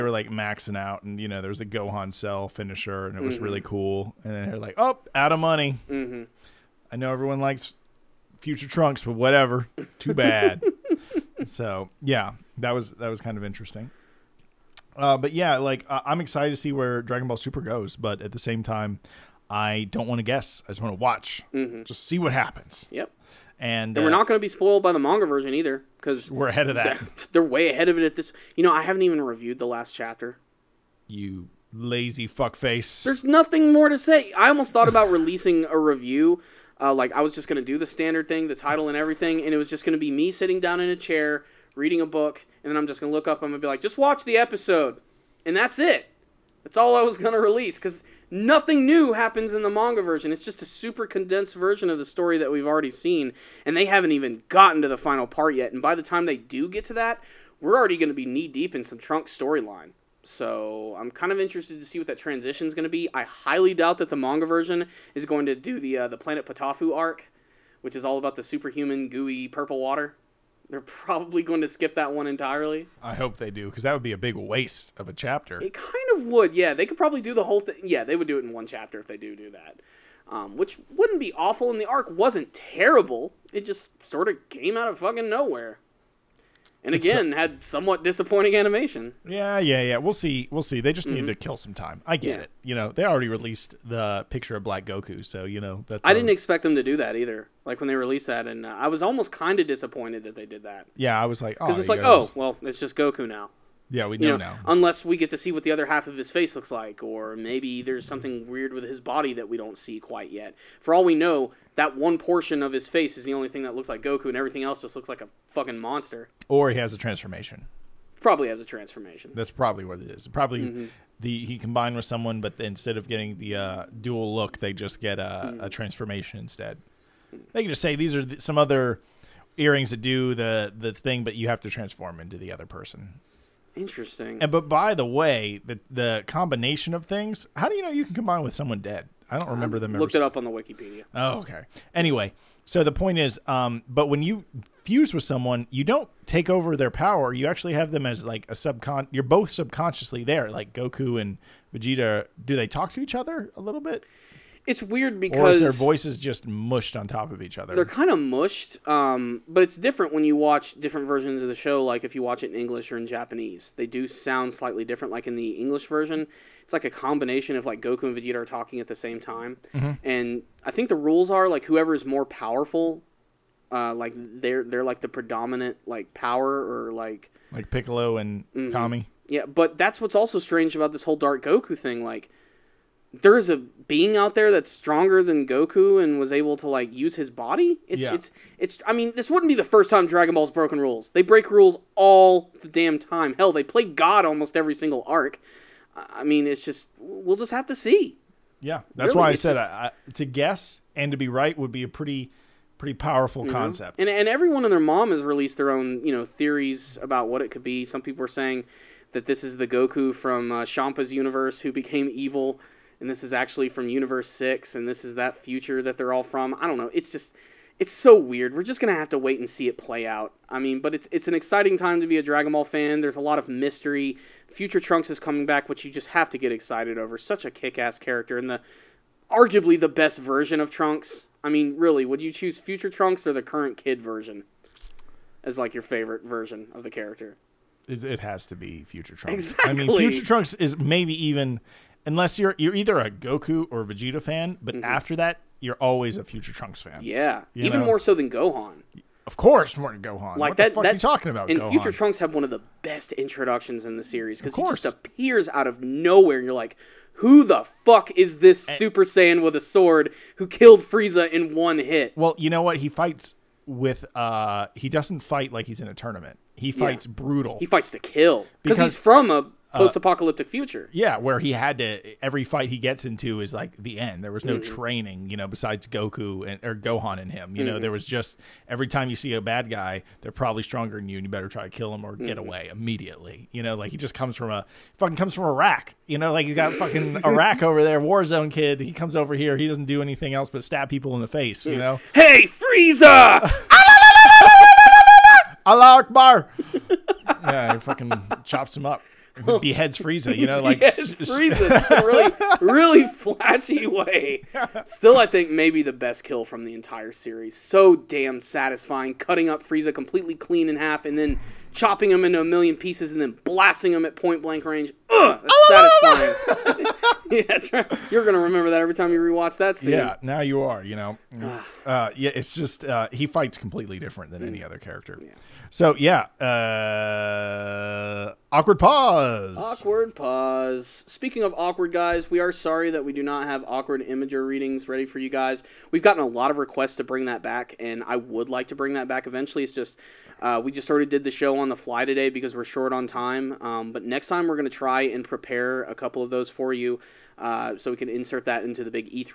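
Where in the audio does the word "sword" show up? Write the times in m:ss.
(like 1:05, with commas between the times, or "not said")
4:19.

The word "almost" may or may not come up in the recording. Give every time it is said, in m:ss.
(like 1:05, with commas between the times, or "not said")
0:34, 1:39, 3:14.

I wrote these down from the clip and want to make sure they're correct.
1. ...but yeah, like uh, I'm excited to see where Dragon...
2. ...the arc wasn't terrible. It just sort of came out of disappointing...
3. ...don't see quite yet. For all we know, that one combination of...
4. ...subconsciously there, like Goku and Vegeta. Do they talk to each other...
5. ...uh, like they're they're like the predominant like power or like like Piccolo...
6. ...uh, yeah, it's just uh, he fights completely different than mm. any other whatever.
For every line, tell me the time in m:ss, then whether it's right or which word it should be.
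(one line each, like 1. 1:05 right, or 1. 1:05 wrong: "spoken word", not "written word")
1. 0:15 right
2. 1:21 wrong: "fucking", not "disappointing"
3. 1:49 wrong: "portion", not "combination"
4. 2:29 right
5. 2:53 right
6. 5:21 wrong: "character", not "whatever".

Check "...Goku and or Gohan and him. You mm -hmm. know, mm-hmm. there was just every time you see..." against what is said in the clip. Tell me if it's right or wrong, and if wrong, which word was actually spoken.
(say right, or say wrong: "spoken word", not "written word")
right.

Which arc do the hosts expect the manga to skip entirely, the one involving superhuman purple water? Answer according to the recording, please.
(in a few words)
Planet Potaufeu arc.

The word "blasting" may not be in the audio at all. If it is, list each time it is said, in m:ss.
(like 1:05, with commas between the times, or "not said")
5:13.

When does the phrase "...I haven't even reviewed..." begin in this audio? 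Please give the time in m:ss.
0:28.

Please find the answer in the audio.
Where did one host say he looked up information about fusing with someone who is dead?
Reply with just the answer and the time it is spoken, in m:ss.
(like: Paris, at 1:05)
Wikipedia, at 2:20.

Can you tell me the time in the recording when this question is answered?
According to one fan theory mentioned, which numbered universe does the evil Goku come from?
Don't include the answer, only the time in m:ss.
3:33.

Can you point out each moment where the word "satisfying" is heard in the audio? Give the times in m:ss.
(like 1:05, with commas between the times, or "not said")
5:08, 5:16.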